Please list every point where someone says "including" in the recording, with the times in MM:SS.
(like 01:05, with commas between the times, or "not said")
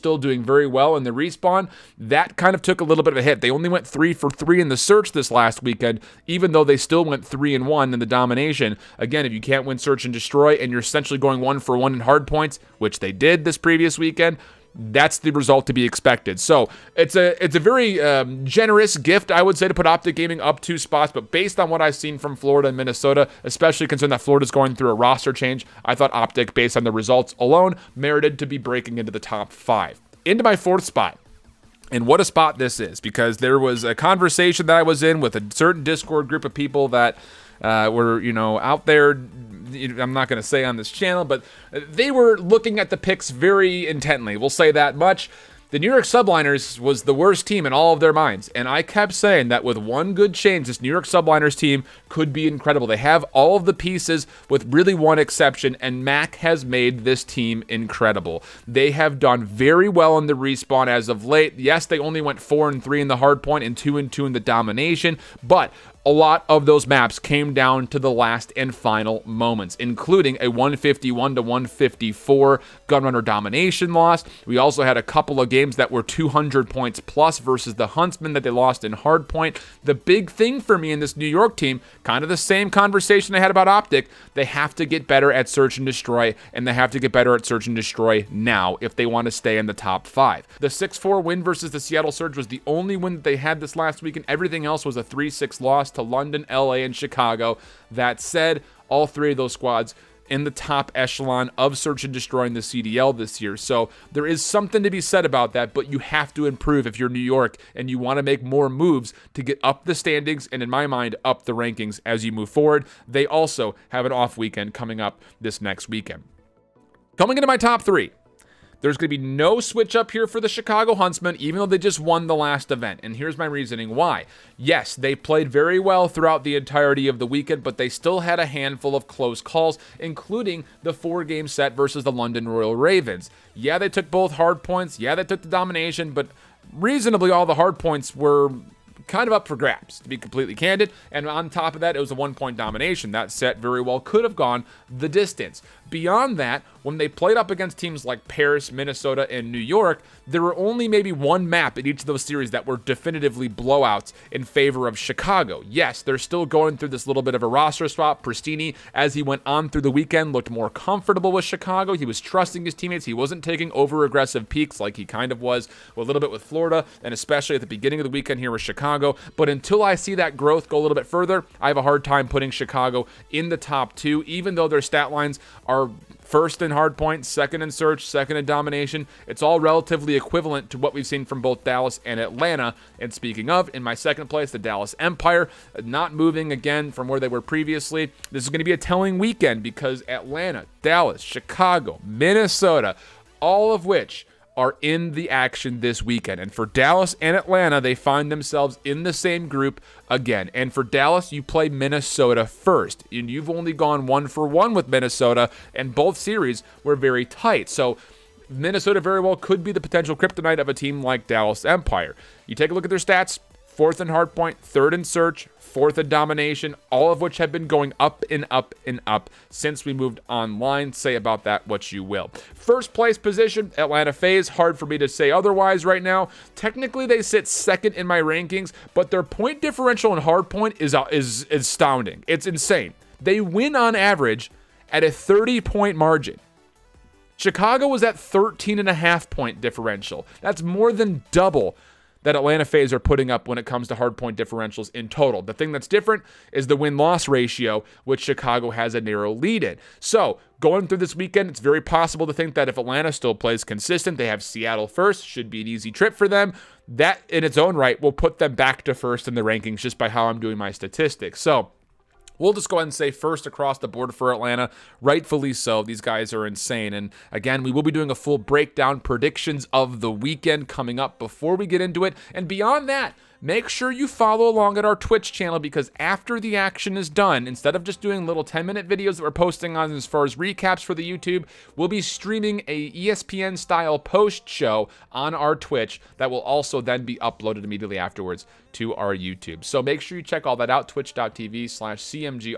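01:09, 02:09.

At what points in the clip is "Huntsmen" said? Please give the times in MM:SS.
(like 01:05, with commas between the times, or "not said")
01:17, 02:00.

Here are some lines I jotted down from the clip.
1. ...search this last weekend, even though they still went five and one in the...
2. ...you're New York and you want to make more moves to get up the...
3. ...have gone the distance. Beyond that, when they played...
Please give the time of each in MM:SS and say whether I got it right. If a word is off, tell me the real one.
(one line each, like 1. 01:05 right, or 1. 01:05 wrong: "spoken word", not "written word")
1. 00:04 wrong: "three", not "five"
2. 01:46 right
3. 02:24 right.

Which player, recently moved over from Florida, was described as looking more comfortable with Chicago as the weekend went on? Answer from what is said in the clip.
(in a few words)
Prestinni.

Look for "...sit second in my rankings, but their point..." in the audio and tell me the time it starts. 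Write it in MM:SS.
03:47.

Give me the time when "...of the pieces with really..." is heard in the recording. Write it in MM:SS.
00:53.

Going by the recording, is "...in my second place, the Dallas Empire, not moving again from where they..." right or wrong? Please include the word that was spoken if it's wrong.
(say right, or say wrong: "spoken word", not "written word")
right.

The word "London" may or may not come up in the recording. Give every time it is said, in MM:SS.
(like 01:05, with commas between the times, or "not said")
01:36, 02:12.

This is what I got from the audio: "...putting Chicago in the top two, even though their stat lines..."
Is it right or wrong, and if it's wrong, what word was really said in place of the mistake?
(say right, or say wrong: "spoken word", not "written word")
right.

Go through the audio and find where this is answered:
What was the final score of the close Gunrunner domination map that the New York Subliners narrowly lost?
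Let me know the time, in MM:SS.
01:10.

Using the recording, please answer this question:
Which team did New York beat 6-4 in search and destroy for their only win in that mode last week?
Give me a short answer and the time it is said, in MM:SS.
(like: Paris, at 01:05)
Seattle Surge, at 01:31.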